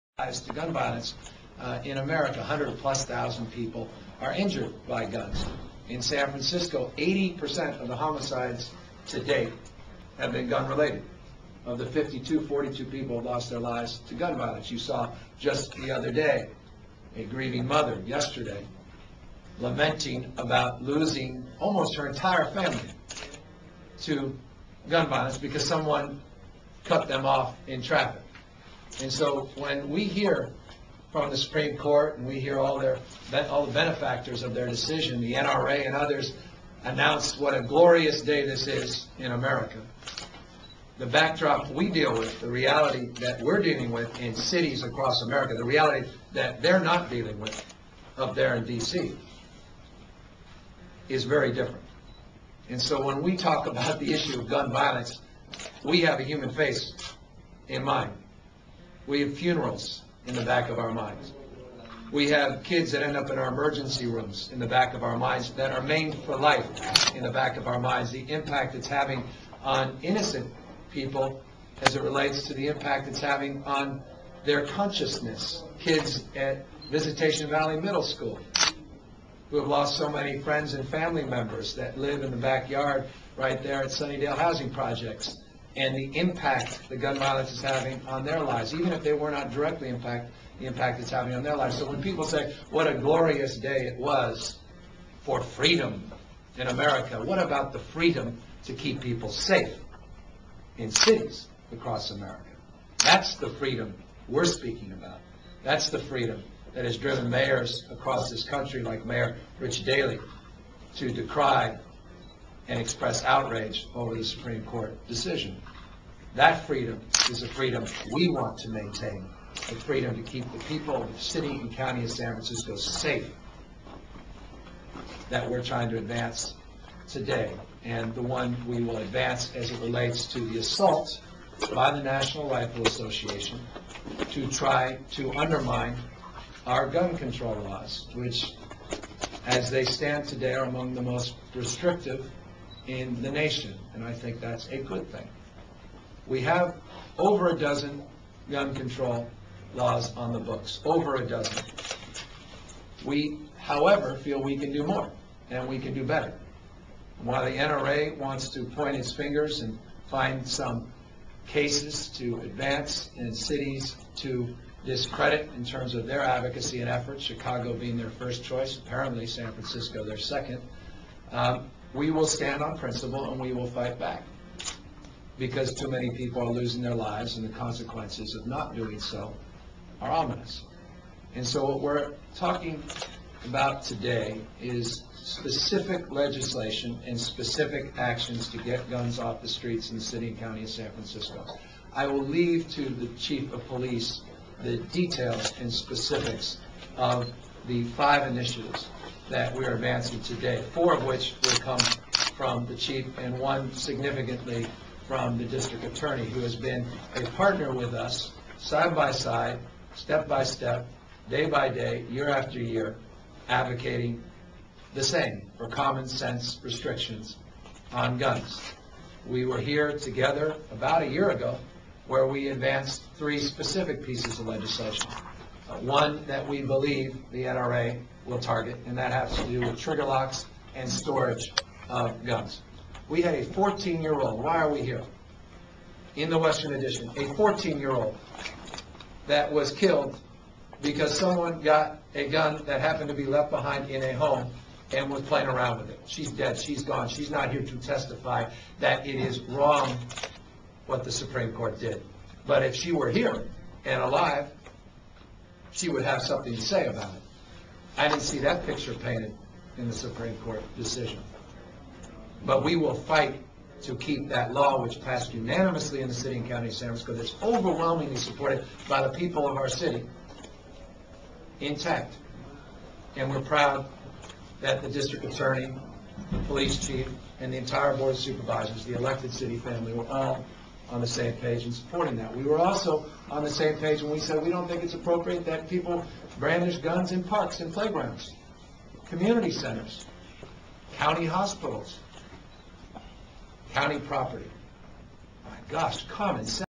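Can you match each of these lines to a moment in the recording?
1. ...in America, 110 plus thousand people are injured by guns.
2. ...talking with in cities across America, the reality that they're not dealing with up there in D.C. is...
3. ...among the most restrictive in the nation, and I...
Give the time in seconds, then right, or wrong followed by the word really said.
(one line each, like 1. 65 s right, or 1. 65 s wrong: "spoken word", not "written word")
1. 1 s wrong: "100", not "110"
2. 43 s wrong: "dealing", not "talking"
3. 140 s right.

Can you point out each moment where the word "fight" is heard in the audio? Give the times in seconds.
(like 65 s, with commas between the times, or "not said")
173 s, 262 s.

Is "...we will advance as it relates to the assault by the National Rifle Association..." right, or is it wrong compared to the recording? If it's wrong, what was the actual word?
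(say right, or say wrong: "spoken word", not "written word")
right.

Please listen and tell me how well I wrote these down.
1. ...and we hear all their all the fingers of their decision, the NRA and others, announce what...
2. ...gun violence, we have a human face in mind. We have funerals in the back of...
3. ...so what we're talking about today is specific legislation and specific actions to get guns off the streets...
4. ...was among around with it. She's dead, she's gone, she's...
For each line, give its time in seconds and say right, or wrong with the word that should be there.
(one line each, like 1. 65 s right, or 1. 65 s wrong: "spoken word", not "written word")
1. 32 s wrong: "benefactors", not "fingers"
2. 54 s right
3. 181 s right
4. 245 s wrong: "playing", not "among".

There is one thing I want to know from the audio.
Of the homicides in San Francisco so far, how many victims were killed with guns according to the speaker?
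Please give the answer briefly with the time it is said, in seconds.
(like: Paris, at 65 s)
42, at 12 s.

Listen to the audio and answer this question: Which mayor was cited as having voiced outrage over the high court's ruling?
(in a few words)
Rich Daley.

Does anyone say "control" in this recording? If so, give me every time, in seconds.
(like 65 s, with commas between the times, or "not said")
137 s, 148 s.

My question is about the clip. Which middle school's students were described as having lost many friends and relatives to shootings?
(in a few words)
Visitation Valley Middle School.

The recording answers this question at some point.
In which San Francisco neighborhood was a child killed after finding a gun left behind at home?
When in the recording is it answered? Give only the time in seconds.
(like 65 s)
236 s.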